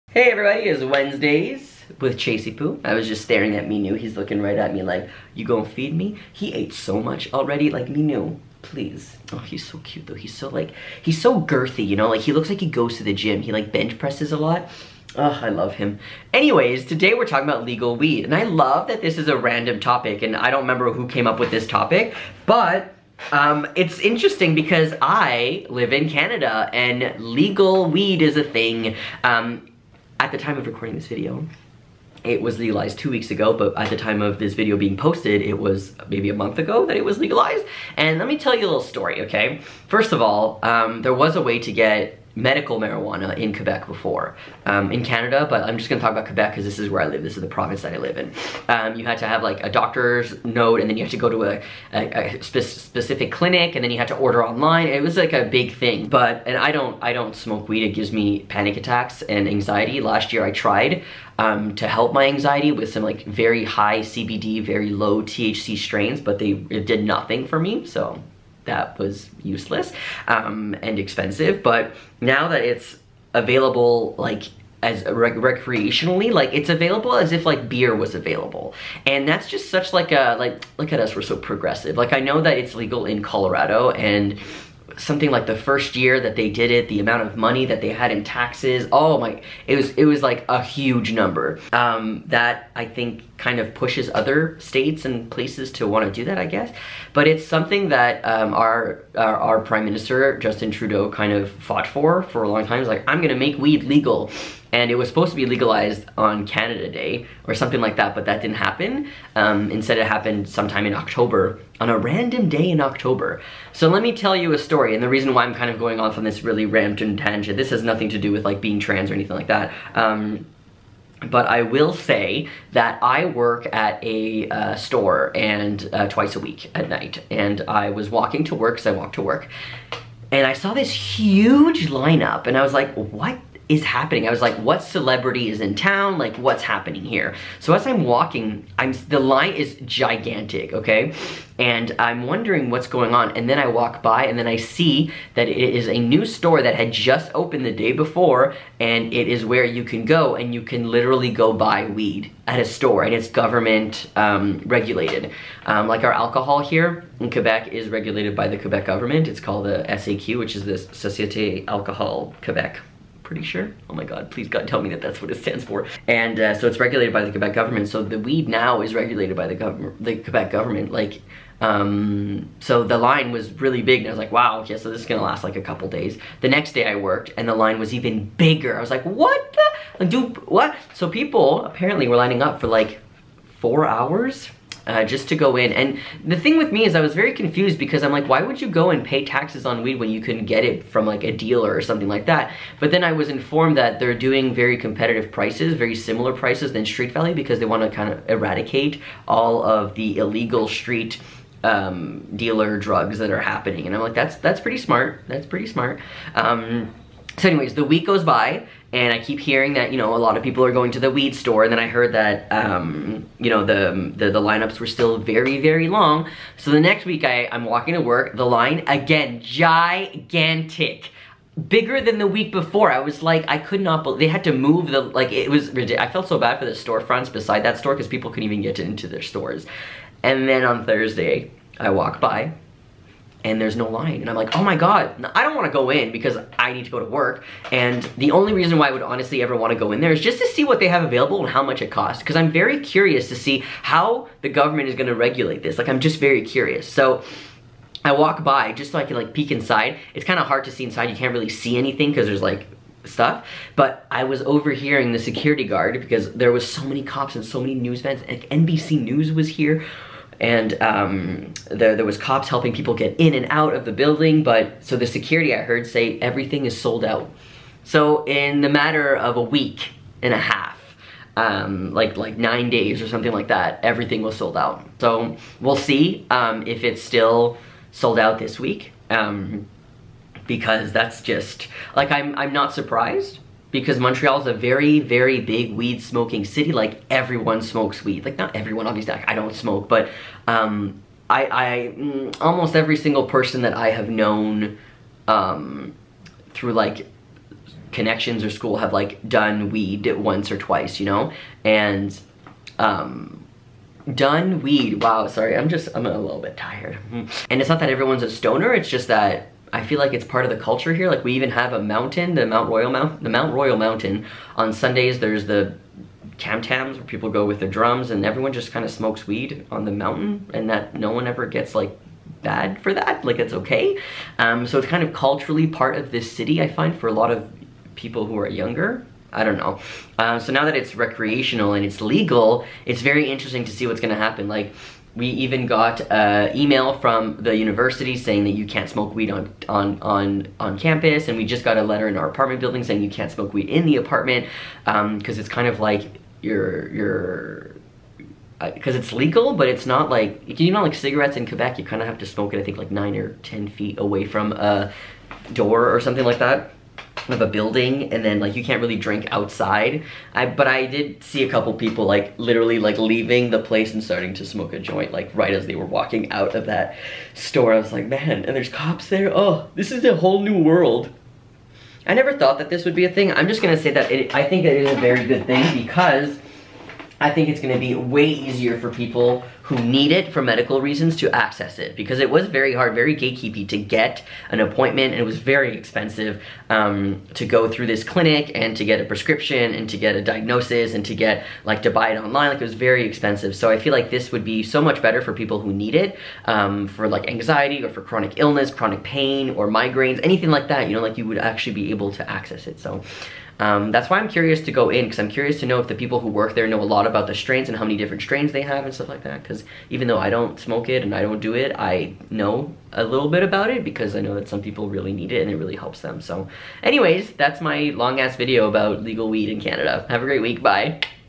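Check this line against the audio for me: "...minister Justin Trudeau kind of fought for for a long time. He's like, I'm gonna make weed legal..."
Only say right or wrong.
right.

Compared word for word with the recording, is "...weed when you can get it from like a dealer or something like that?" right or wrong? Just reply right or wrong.
right.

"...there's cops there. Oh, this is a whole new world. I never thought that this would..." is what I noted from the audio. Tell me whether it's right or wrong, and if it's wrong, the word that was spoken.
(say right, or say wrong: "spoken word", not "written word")
right.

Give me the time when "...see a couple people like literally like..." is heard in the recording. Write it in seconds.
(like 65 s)
361 s.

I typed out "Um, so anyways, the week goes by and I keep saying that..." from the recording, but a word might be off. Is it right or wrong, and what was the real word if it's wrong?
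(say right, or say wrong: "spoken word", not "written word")
wrong: "hearing", not "saying".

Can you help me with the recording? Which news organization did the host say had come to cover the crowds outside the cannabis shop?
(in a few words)
NBC News.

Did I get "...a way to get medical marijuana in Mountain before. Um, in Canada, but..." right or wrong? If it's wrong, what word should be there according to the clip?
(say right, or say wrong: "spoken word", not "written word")
wrong: "Quebec", not "Mountain".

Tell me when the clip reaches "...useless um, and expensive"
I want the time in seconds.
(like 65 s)
69 s.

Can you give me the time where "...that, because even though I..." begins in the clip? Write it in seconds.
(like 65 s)
409 s.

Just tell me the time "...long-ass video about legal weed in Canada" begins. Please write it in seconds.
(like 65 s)
417 s.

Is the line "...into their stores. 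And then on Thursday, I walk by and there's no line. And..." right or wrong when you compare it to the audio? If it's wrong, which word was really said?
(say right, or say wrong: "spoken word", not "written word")
right.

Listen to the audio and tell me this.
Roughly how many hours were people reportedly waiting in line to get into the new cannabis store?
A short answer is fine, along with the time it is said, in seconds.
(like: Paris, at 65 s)
4 hours, at 183 s.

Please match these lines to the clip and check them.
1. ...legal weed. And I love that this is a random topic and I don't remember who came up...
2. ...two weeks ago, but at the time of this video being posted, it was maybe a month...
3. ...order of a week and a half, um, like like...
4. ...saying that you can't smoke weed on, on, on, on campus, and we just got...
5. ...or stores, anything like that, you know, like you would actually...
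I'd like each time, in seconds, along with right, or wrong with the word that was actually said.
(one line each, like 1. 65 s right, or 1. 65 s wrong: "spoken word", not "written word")
1. 17 s right
2. 32 s right
3. 268 s wrong: "matter", not "order"
4. 338 s right
5. 399 s wrong: "migraines", not "stores".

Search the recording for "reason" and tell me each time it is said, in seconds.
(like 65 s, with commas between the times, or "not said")
115 s, 238 s, 380 s.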